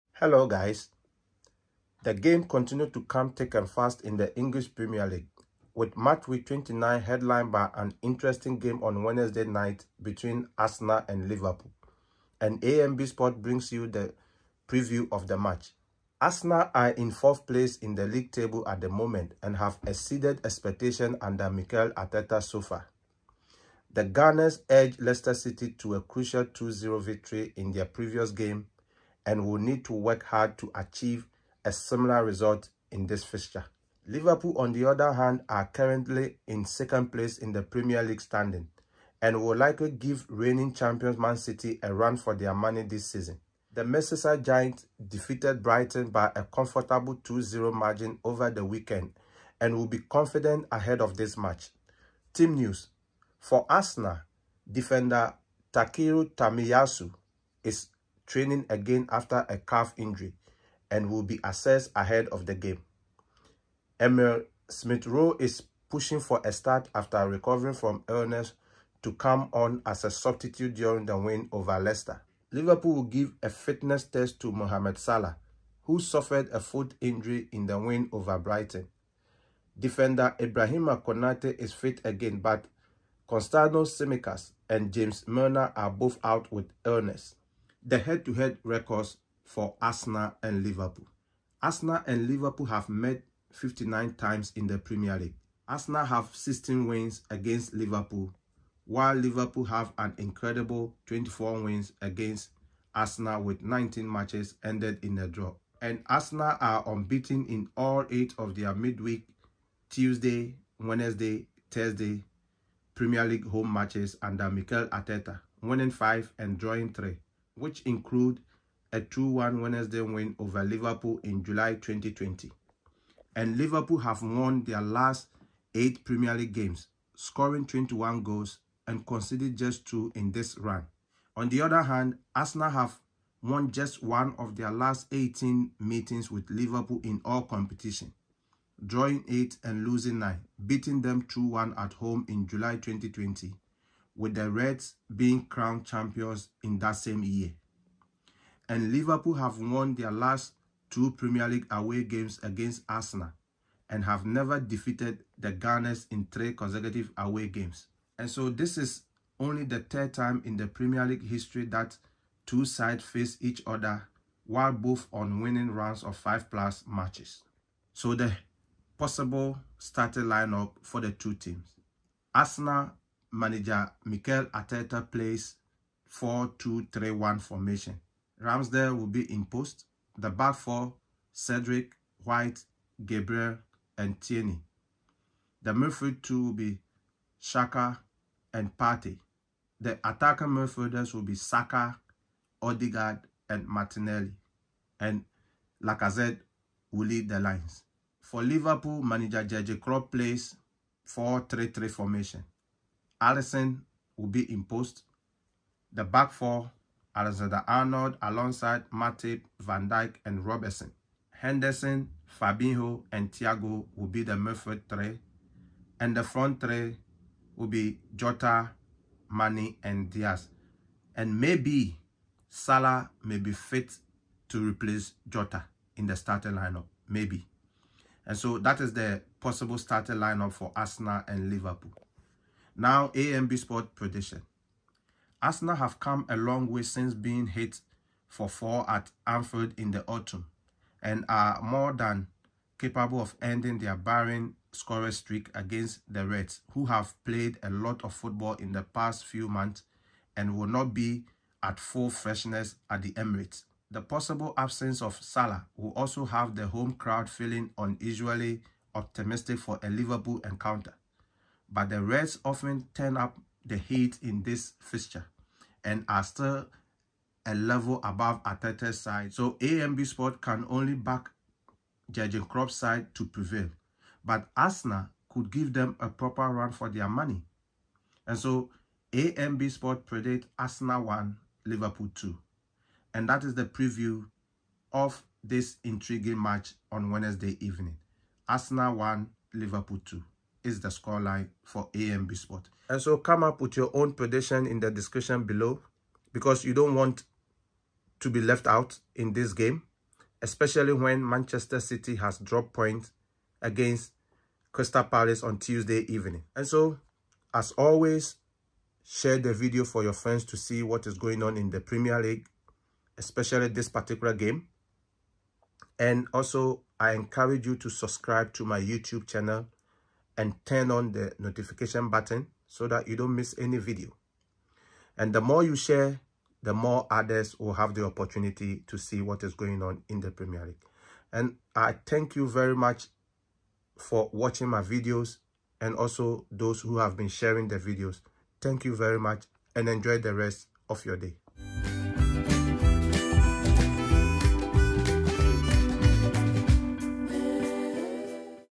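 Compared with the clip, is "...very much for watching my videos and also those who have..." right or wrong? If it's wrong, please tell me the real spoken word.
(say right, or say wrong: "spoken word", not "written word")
right.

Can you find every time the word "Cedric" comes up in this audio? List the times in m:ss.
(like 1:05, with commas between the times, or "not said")
3:01.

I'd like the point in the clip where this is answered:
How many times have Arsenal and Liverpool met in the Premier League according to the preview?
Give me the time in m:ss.
1:33.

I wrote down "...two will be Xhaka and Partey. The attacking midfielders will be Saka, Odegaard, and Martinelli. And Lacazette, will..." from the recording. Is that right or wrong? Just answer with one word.
right.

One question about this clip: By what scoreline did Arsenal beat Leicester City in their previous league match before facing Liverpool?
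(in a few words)
2-0.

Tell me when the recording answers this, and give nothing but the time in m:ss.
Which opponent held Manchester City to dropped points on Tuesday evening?
5:04.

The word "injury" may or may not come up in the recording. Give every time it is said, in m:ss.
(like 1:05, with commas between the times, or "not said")
0:59, 1:17.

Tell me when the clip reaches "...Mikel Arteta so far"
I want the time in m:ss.
0:21.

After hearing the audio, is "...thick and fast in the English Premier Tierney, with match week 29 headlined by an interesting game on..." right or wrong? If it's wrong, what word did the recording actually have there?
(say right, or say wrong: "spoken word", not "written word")
wrong: "League", not "Tierney".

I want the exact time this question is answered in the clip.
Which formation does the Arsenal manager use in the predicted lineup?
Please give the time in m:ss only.
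2:56.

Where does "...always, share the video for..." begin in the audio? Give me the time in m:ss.
5:07.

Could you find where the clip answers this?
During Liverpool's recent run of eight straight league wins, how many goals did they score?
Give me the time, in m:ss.
2:07.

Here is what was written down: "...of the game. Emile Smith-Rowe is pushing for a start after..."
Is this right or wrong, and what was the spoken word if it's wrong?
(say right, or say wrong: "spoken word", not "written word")
right.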